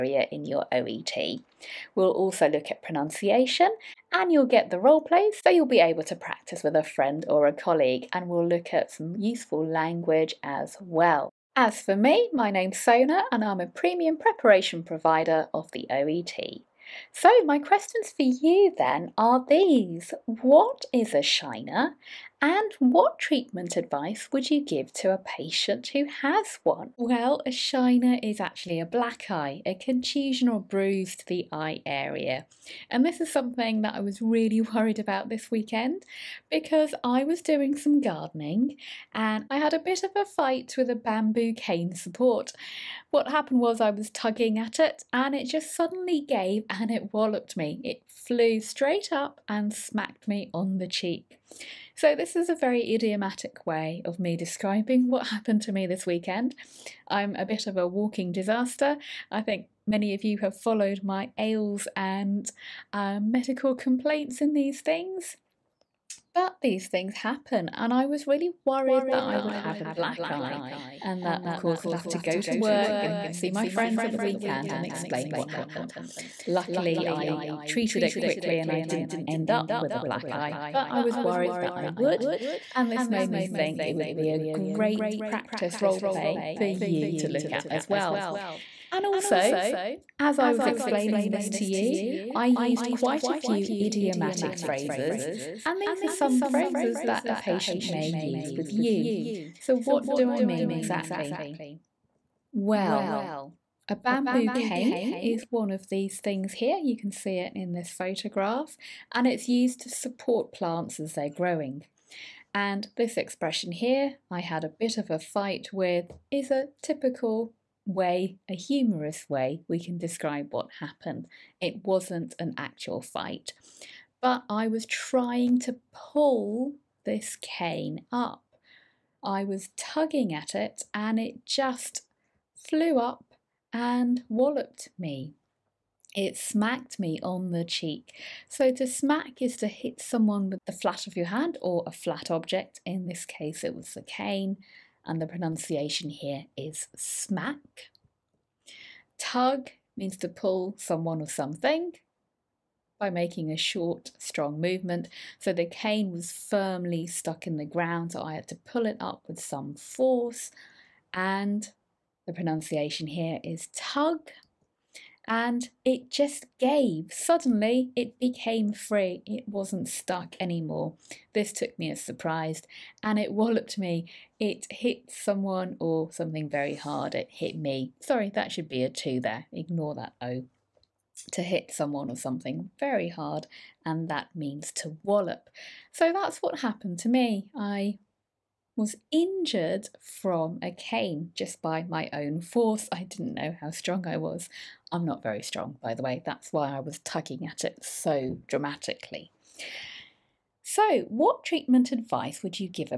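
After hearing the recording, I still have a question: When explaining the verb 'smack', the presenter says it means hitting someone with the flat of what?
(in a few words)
your hand.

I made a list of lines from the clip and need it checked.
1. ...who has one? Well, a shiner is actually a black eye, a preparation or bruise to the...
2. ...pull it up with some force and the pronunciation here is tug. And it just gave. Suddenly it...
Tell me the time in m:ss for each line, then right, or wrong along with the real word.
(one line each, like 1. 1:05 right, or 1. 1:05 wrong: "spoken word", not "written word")
1. 0:25 wrong: "contusion", not "preparation"
2. 2:38 right.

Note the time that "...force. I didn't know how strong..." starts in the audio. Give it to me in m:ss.
3:12.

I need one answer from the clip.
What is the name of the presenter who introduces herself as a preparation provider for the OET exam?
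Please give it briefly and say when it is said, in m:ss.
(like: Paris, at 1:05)
Sona, at 0:12.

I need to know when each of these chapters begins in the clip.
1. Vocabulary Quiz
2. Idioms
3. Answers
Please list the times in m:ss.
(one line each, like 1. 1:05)
1. 0:16
2. 0:36
3. 0:26.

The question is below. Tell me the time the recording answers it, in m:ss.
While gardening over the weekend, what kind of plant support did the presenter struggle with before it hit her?
0:40.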